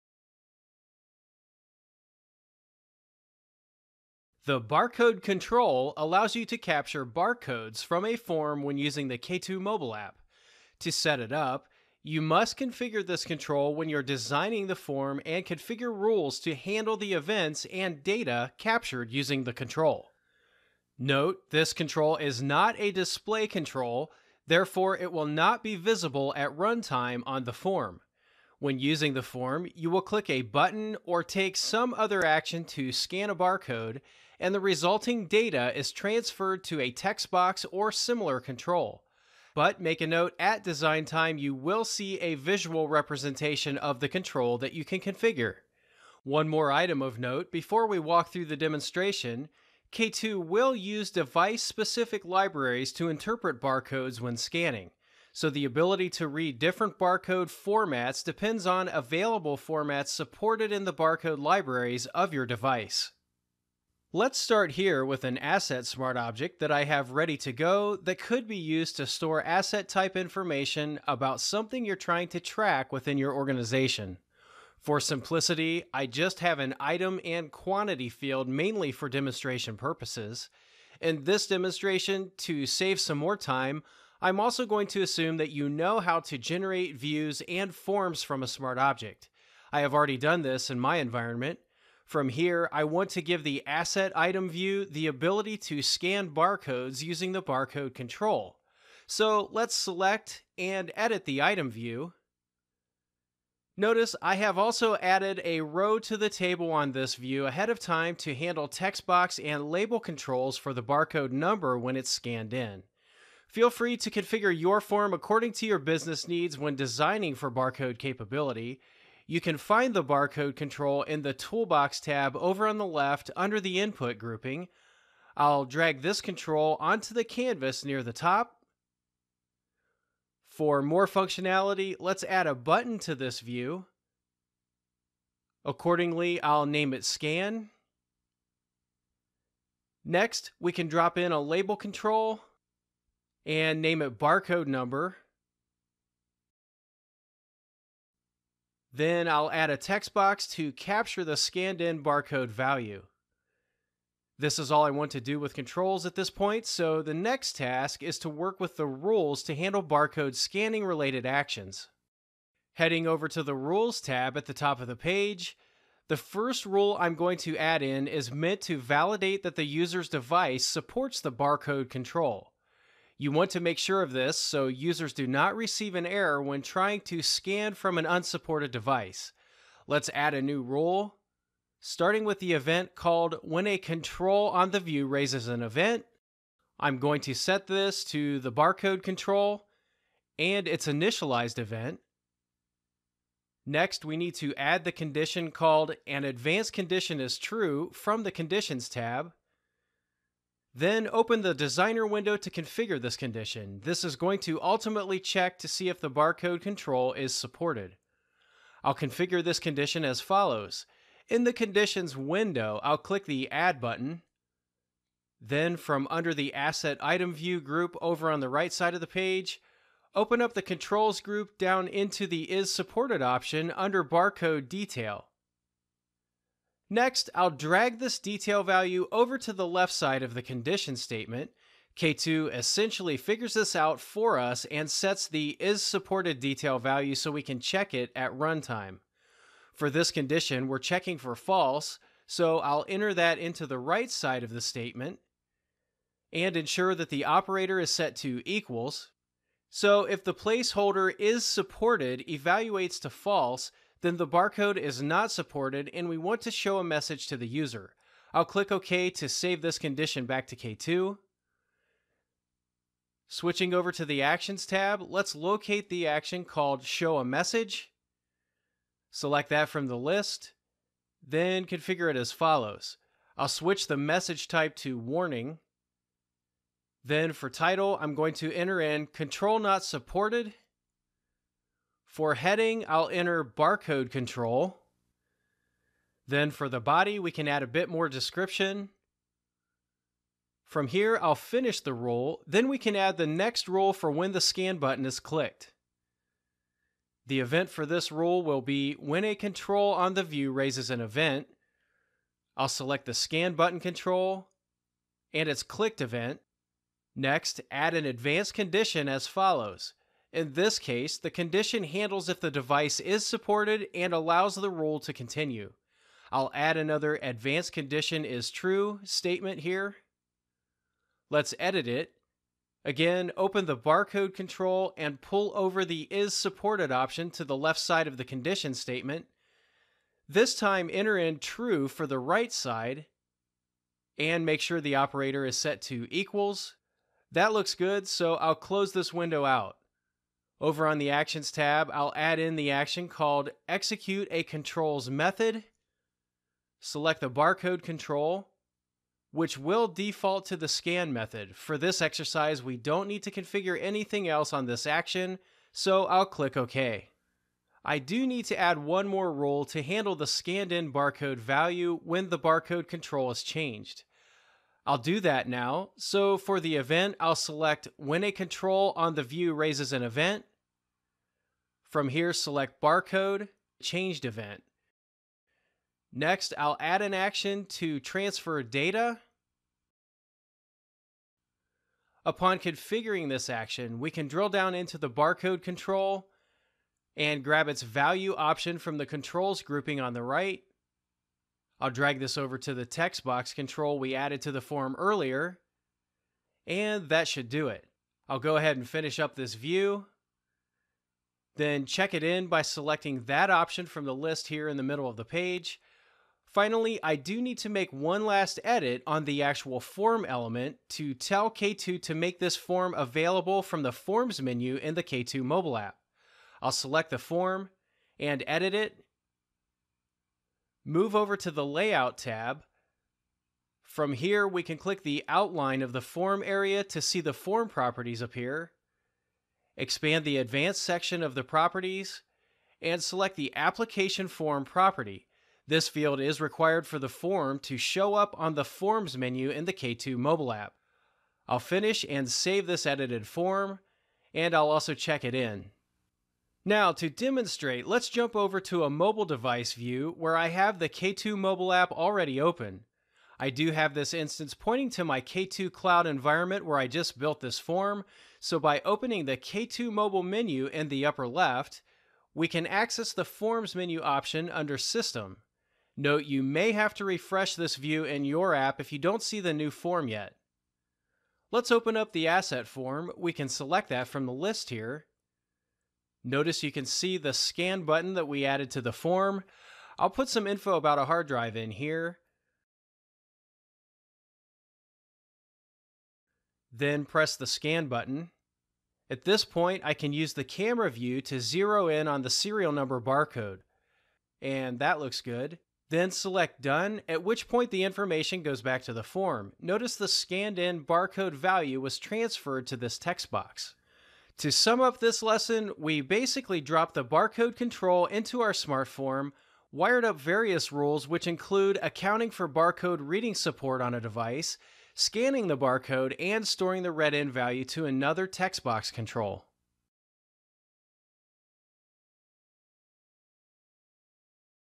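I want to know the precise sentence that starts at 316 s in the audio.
I'll add another advanced condition is true statement here.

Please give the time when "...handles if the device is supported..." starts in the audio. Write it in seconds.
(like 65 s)
311 s.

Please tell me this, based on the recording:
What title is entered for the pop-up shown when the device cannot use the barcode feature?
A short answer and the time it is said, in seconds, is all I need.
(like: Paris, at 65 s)
Control Not Supported, at 279 s.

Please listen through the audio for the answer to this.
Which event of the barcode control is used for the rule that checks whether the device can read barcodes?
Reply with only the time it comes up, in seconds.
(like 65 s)
190 s.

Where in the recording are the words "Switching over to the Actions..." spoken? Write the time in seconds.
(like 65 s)
263 s.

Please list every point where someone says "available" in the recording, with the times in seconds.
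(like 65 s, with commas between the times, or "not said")
58 s, 412 s.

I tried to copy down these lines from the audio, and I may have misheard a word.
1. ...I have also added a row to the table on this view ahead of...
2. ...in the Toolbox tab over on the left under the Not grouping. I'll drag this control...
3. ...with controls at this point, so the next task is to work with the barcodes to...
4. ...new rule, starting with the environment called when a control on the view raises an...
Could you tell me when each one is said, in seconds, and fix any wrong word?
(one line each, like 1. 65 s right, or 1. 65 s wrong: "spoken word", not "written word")
1. 104 s right
2. 121 s wrong: "Input", not "Not"
3. 155 s wrong: "rules", not "barcodes"
4. 180 s wrong: "event", not "environment".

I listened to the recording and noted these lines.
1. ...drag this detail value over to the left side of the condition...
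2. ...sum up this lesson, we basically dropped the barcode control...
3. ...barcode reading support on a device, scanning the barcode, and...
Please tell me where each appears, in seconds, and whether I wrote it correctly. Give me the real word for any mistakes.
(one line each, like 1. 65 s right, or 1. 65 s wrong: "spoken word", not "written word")
1. 227 s right
2. 504 s right
3. 512 s right.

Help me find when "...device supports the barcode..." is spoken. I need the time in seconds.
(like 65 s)
170 s.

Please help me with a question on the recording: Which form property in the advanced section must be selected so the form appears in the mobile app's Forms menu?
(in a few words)
application form.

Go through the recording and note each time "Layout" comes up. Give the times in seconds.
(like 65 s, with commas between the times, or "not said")
421 s.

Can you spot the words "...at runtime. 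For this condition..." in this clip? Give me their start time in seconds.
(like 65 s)
238 s.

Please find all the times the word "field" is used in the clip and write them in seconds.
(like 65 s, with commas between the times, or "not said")
78 s, 435 s.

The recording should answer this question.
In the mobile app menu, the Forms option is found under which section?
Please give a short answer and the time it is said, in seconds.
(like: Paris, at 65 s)
System, at 464 s.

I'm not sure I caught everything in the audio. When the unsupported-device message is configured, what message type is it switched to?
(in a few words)
Warning.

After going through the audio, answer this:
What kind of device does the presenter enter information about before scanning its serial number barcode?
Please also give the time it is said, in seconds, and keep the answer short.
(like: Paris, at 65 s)
hard drive, at 481 s.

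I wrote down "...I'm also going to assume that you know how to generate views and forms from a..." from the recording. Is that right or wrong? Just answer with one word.
right.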